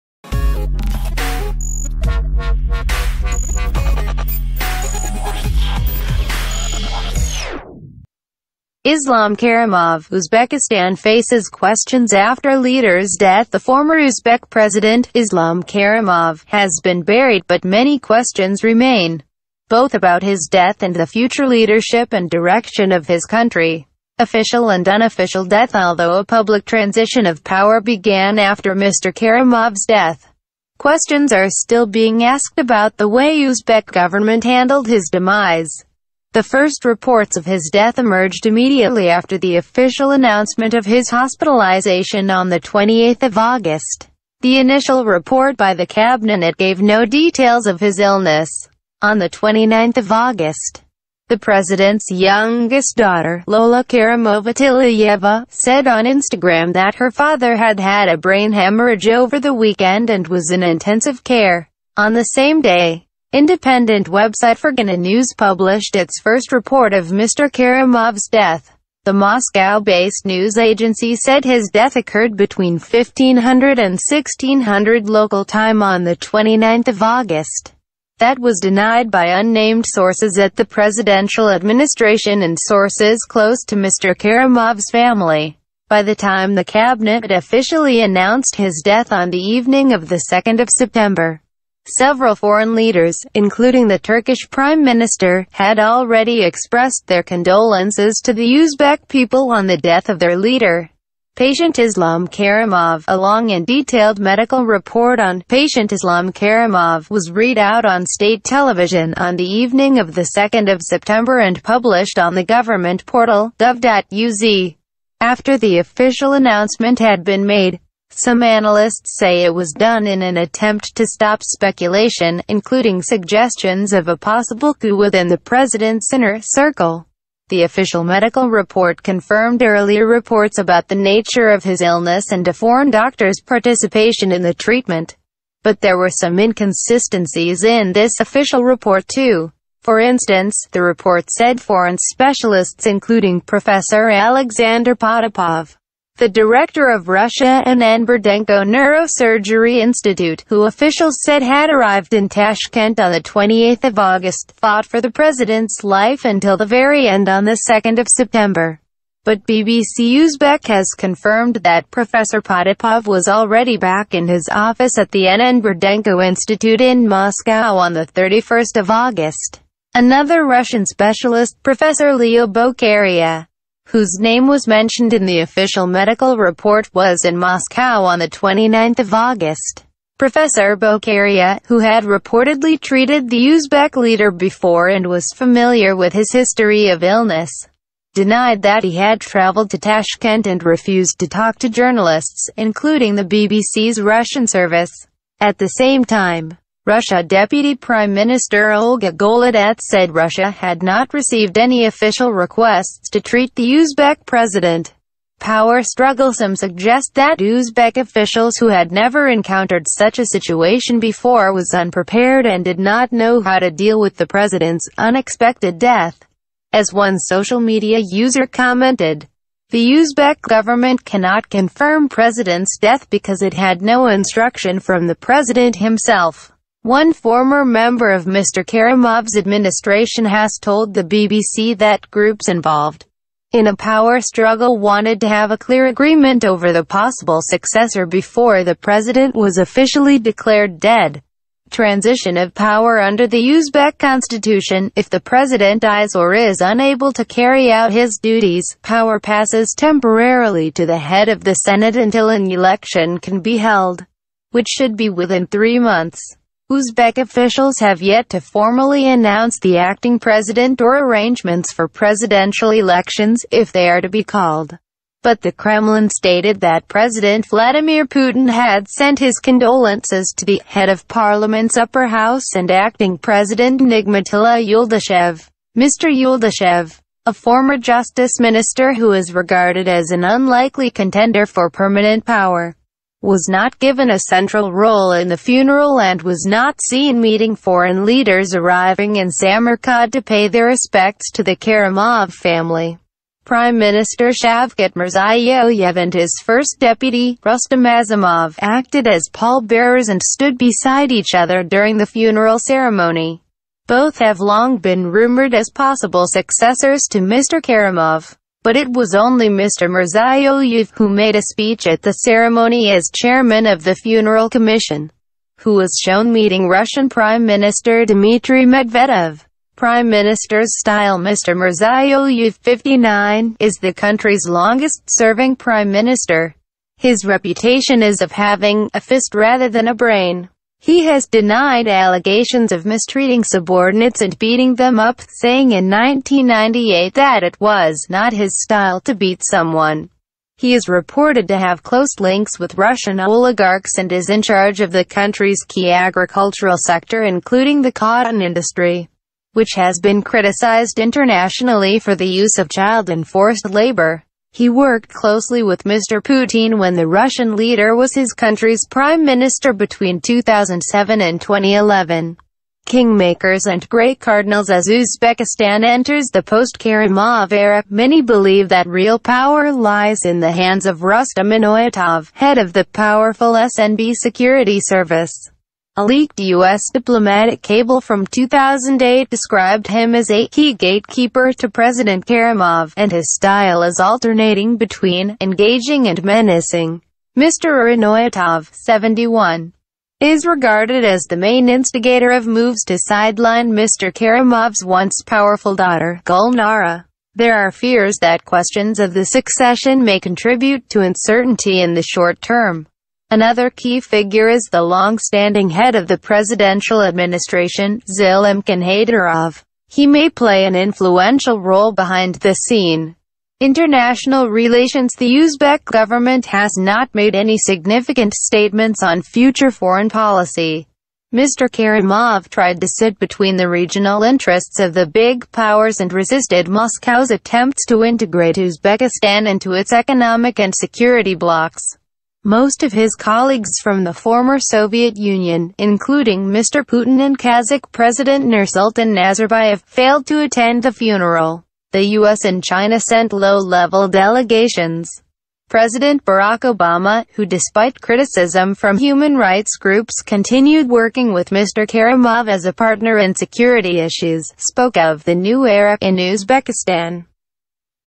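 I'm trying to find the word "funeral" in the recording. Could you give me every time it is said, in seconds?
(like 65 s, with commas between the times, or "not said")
285 s, 302 s, 313 s, 440 s.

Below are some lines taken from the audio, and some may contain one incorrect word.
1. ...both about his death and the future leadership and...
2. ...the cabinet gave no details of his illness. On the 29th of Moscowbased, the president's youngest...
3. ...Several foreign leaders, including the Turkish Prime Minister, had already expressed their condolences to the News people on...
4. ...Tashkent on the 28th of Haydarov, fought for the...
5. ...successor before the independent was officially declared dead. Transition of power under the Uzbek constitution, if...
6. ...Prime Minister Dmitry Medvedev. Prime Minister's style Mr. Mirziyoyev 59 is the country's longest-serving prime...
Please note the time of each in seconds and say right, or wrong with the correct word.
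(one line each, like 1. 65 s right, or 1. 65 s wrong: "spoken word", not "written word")
1. 19 s right
2. 45 s wrong: "August", not "Moscowbased"
3. 91 s wrong: "Uzbek", not "News"
4. 152 s wrong: "August", not "Haydarov"
5. 237 s wrong: "president", not "independent"
6. 317 s right.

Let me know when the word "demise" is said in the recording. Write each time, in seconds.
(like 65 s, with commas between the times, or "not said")
35 s.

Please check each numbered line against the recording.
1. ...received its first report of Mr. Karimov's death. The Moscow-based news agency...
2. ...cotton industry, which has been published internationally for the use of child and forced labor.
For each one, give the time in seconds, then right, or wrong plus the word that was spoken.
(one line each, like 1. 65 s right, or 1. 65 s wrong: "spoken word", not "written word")
1. 65 s wrong: "published", not "received"
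2. 347 s wrong: "criticized", not "published".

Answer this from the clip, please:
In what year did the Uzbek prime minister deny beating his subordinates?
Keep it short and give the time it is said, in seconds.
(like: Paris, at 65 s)
1998, at 335 s.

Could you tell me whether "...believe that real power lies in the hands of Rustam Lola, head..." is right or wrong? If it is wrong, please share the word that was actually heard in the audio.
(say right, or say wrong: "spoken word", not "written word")
wrong: "Inoyatov", not "Lola".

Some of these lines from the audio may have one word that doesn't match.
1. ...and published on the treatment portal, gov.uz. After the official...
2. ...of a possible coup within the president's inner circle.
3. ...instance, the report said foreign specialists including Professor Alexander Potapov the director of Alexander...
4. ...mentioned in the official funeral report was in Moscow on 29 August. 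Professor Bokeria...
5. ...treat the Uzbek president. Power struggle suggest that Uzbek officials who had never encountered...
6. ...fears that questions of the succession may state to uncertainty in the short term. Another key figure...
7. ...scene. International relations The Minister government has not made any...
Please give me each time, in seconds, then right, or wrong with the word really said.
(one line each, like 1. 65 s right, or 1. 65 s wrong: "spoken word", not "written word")
1. 111 s wrong: "government", not "treatment"
2. 123 s right
3. 140 s wrong: "Russia", not "Alexander"
4. 174 s wrong: "medical", not "funeral"
5. 203 s right
6. 397 s wrong: "contribute", not "state"
7. 412 s wrong: "Uzbek", not "Minister".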